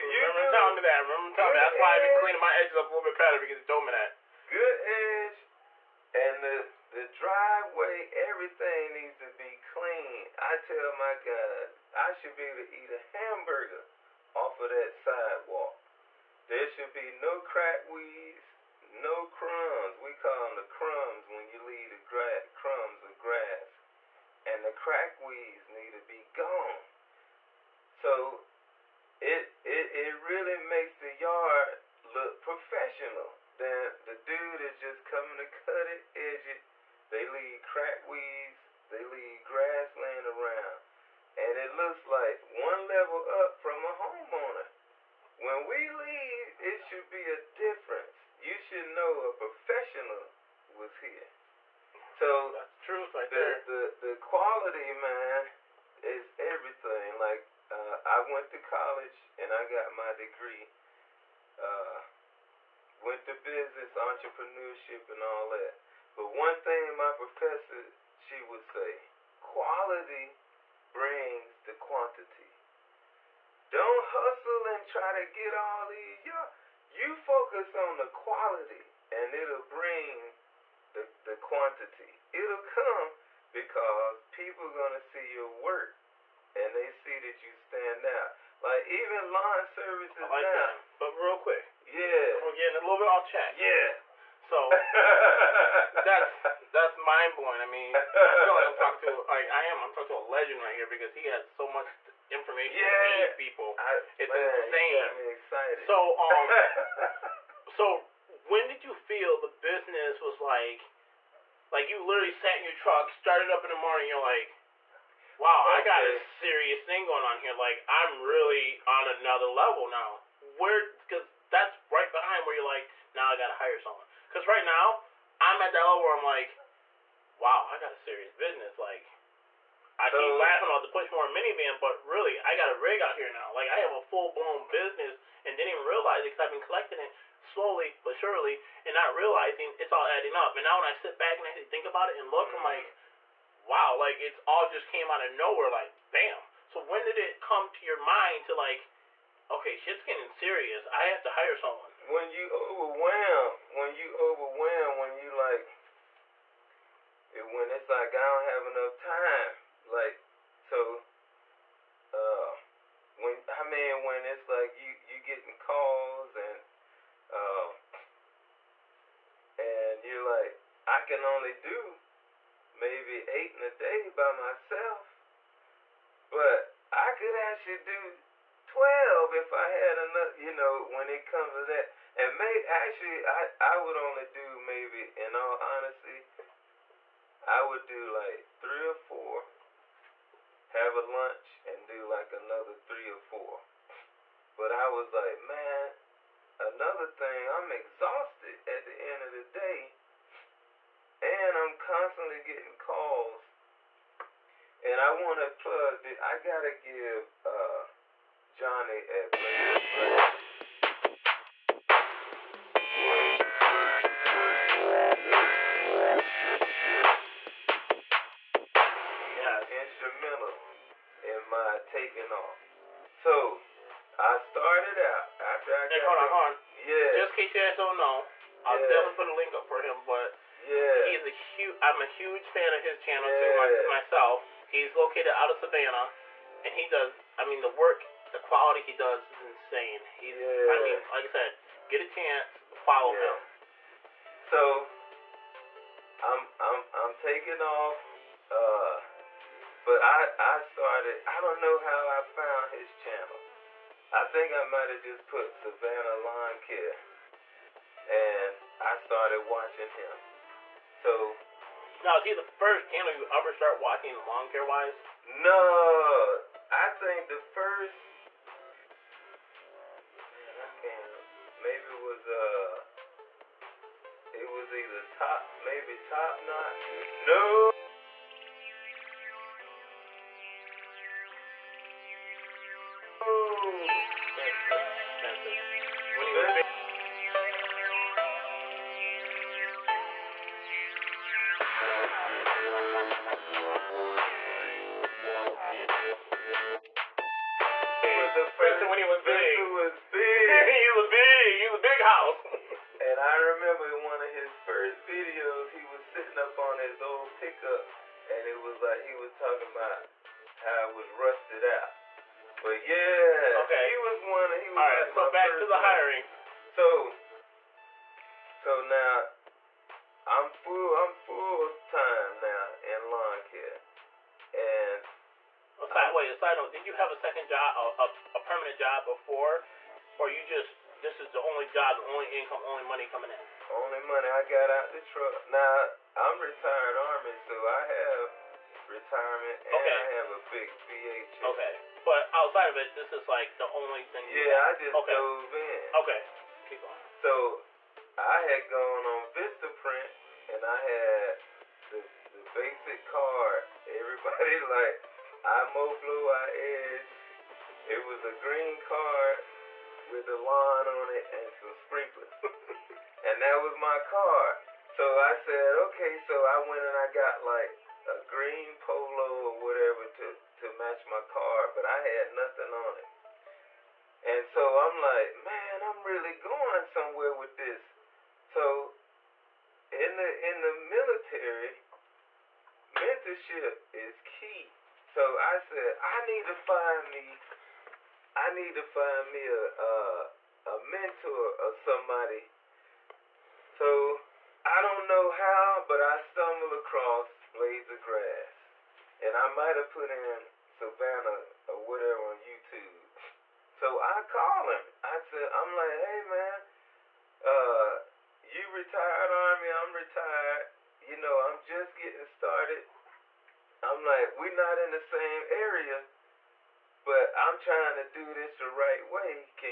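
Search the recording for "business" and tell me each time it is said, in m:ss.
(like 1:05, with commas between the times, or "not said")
1:03, 1:49, 2:08, 2:14.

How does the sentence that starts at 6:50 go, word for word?
You know, I'm just getting started.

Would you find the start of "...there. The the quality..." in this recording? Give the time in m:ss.
0:53.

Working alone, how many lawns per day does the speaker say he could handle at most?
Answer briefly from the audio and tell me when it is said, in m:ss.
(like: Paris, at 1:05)
8, at 2:53.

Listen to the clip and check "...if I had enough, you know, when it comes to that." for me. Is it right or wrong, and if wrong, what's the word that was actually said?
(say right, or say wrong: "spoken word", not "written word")
right.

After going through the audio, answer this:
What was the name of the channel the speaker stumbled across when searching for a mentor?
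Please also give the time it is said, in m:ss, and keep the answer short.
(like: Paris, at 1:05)
Blades of Grass, at 6:37.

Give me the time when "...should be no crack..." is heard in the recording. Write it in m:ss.
0:16.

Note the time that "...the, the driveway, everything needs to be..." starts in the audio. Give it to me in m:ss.
0:06.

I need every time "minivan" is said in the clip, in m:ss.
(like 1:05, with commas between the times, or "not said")
2:11.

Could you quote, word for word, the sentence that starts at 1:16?
Y'all, you focus on the quality, and it'll bring the, the quantity.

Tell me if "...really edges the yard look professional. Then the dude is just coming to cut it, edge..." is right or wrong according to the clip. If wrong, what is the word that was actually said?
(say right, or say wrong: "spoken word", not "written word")
wrong: "makes", not "edges".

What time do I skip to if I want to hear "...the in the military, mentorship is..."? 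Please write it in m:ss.
6:20.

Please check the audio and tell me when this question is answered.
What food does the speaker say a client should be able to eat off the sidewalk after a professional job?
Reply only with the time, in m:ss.
0:13.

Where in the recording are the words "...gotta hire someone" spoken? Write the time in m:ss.
2:03.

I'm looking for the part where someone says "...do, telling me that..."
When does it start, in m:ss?
0:00.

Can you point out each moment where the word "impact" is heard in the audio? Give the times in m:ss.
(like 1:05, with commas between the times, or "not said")
not said.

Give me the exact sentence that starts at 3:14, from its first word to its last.
But I was like, man, another thing, I'm exhausted at the end of the day and I'm constantly getting calls.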